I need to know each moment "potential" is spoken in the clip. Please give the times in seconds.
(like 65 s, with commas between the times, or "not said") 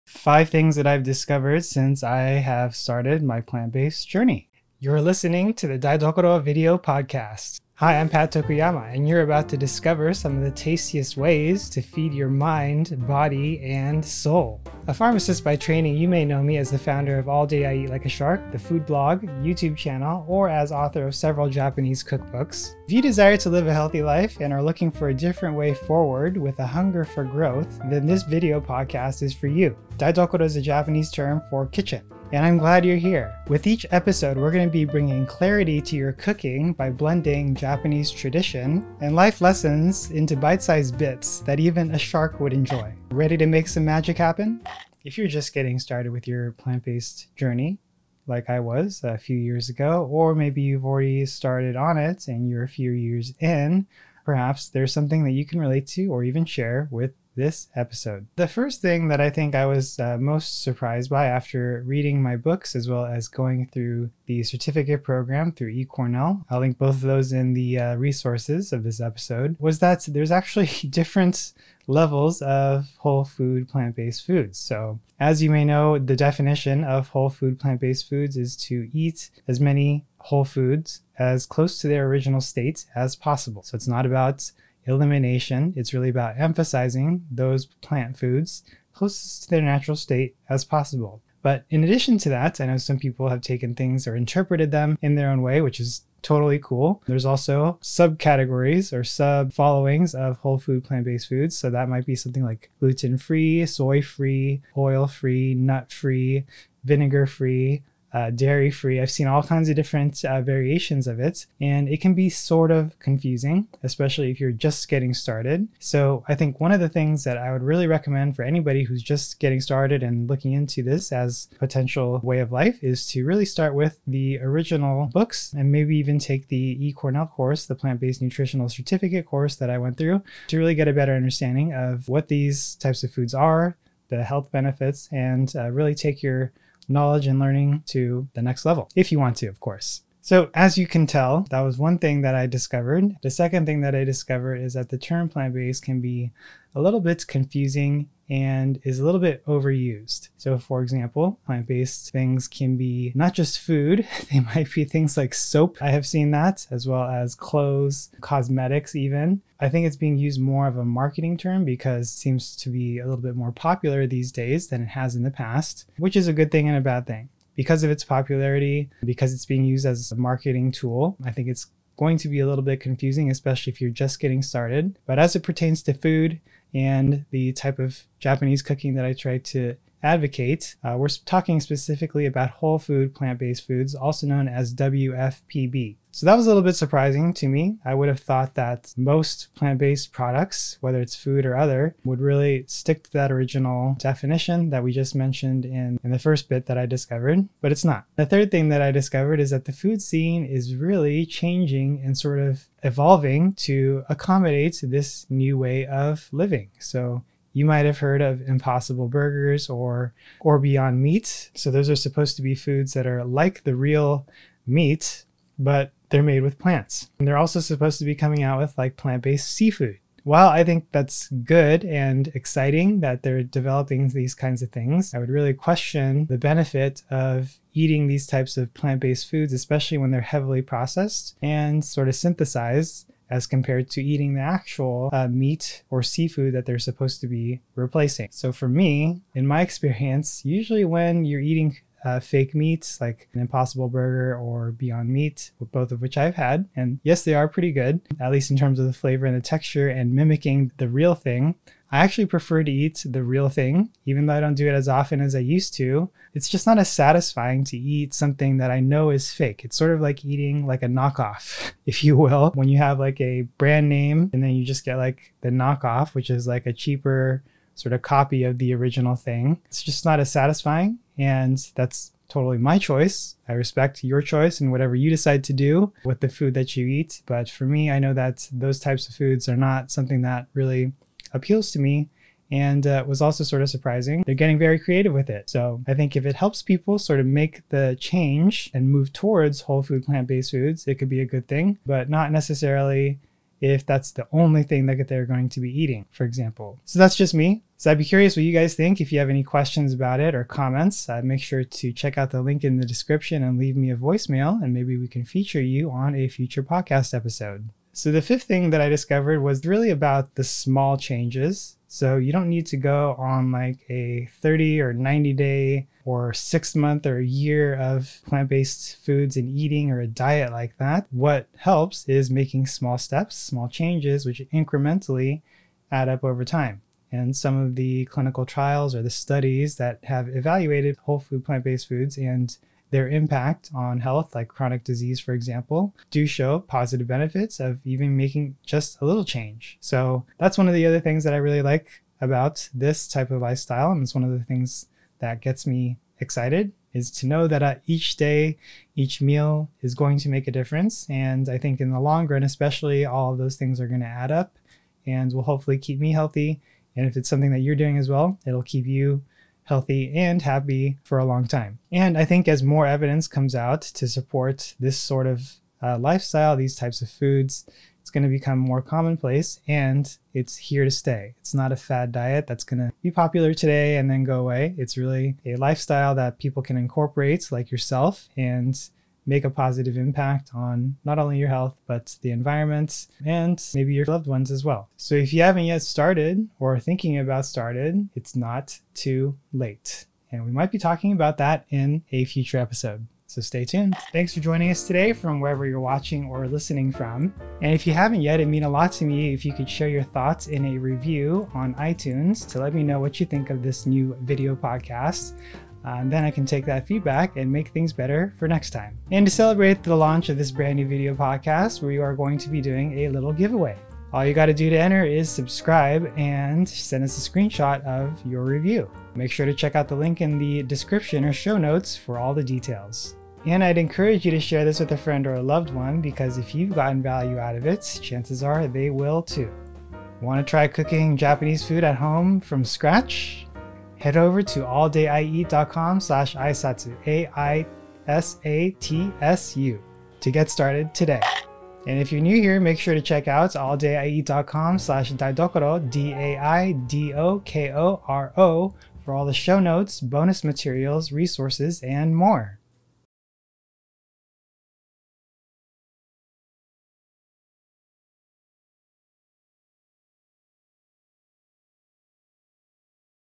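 121 s.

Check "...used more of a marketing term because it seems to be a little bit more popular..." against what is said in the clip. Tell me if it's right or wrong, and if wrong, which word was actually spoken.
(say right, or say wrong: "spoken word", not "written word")
right.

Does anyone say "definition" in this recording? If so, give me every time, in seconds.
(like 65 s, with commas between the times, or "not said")
76 s, 193 s.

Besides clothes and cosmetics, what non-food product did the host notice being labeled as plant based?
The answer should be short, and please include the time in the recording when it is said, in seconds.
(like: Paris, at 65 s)
Soap, at 155 s.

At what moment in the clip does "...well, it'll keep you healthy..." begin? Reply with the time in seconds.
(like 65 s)
358 s.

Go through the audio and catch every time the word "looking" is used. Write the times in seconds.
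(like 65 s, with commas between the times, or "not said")
24 s, 120 s.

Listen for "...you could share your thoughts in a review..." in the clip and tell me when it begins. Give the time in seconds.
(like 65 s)
399 s.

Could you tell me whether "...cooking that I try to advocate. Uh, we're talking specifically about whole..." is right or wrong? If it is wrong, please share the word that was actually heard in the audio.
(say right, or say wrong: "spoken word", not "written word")
right.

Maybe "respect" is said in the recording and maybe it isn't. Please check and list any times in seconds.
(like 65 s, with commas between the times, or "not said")
273 s.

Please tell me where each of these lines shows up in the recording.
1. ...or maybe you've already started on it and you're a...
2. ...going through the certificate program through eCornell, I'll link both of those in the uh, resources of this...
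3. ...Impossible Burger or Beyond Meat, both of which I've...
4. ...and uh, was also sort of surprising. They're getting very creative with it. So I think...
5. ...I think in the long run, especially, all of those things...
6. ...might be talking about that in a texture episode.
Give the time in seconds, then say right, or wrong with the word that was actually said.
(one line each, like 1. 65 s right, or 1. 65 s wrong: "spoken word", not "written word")
1. 50 s right
2. 63 s right
3. 243 s right
4. 282 s right
5. 351 s right
6. 390 s wrong: "future", not "texture".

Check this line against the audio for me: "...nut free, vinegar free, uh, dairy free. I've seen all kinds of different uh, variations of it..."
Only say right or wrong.
right.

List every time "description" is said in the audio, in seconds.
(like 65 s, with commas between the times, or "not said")
302 s, 420 s.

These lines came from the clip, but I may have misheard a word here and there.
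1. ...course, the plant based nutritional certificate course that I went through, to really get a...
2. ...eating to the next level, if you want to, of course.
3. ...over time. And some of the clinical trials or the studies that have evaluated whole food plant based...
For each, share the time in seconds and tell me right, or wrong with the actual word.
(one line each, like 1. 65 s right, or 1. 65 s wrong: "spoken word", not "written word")
1. 127 s right
2. 137 s wrong: "learning", not "eating"
3. 326 s right.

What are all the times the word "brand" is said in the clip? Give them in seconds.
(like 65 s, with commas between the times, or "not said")
263 s, 410 s.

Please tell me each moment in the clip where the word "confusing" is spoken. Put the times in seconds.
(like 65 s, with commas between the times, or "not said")
112 s, 147 s, 172 s.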